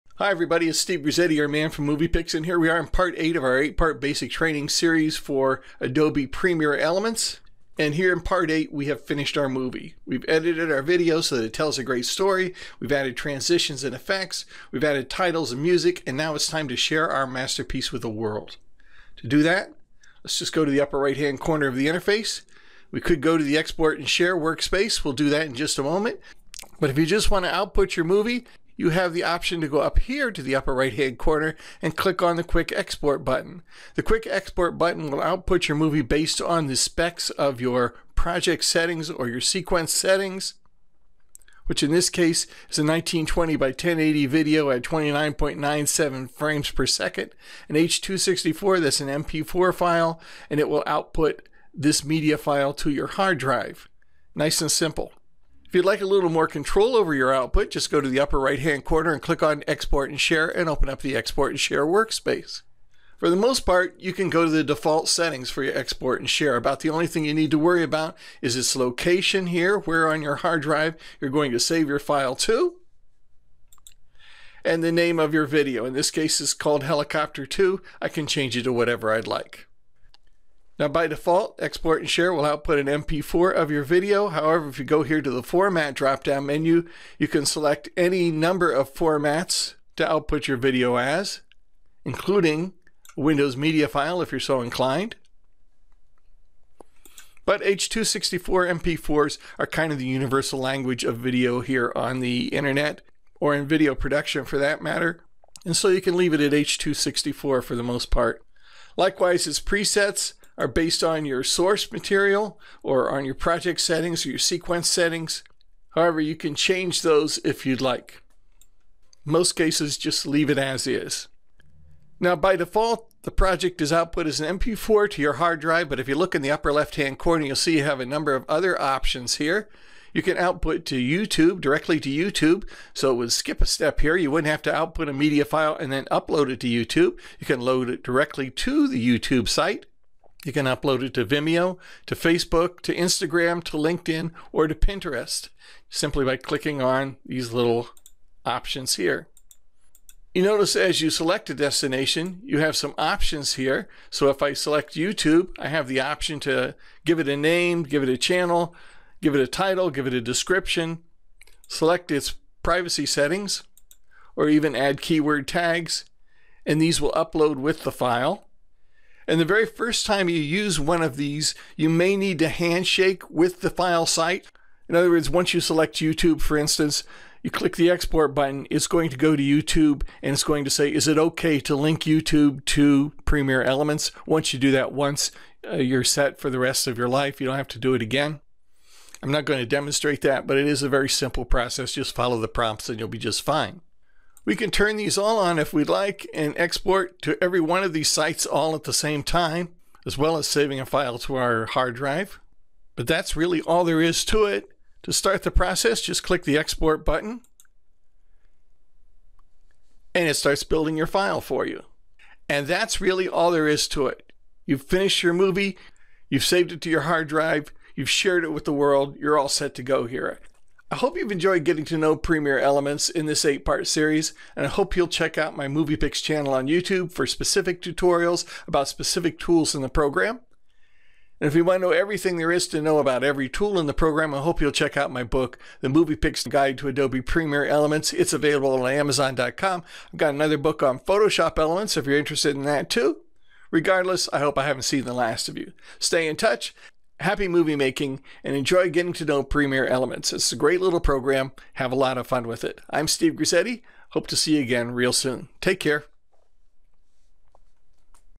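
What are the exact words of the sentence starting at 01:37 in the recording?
But H264 MP4s are kind of the universal language of video here on the internet, or in video production for that matter.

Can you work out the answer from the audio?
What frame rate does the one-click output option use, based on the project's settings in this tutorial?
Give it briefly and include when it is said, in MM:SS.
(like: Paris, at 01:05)
29.97 frames per second, at 00:44.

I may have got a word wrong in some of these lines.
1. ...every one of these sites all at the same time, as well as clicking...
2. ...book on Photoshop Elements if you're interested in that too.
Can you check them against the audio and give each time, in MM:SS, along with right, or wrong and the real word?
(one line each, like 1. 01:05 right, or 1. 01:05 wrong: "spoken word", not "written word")
1. 03:17 wrong: "saving", not "clicking"
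2. 04:00 right.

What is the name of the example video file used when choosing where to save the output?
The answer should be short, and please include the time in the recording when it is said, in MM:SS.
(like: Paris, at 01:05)
Helicopter 2, at 01:16.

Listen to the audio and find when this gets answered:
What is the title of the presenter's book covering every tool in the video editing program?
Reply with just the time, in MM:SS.
03:55.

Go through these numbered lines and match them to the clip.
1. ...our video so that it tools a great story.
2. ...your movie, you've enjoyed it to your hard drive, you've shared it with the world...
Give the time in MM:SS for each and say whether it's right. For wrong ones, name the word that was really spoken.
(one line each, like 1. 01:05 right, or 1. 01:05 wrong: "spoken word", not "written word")
1. 00:10 wrong: "tells", not "tools"
2. 03:35 wrong: "saved", not "enjoyed".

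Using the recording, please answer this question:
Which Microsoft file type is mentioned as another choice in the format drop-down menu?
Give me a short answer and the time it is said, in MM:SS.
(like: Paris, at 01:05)
Windows media file, at 01:33.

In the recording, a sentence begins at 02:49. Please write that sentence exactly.
And the very first time you use one of these, you may need to handshake with the file site.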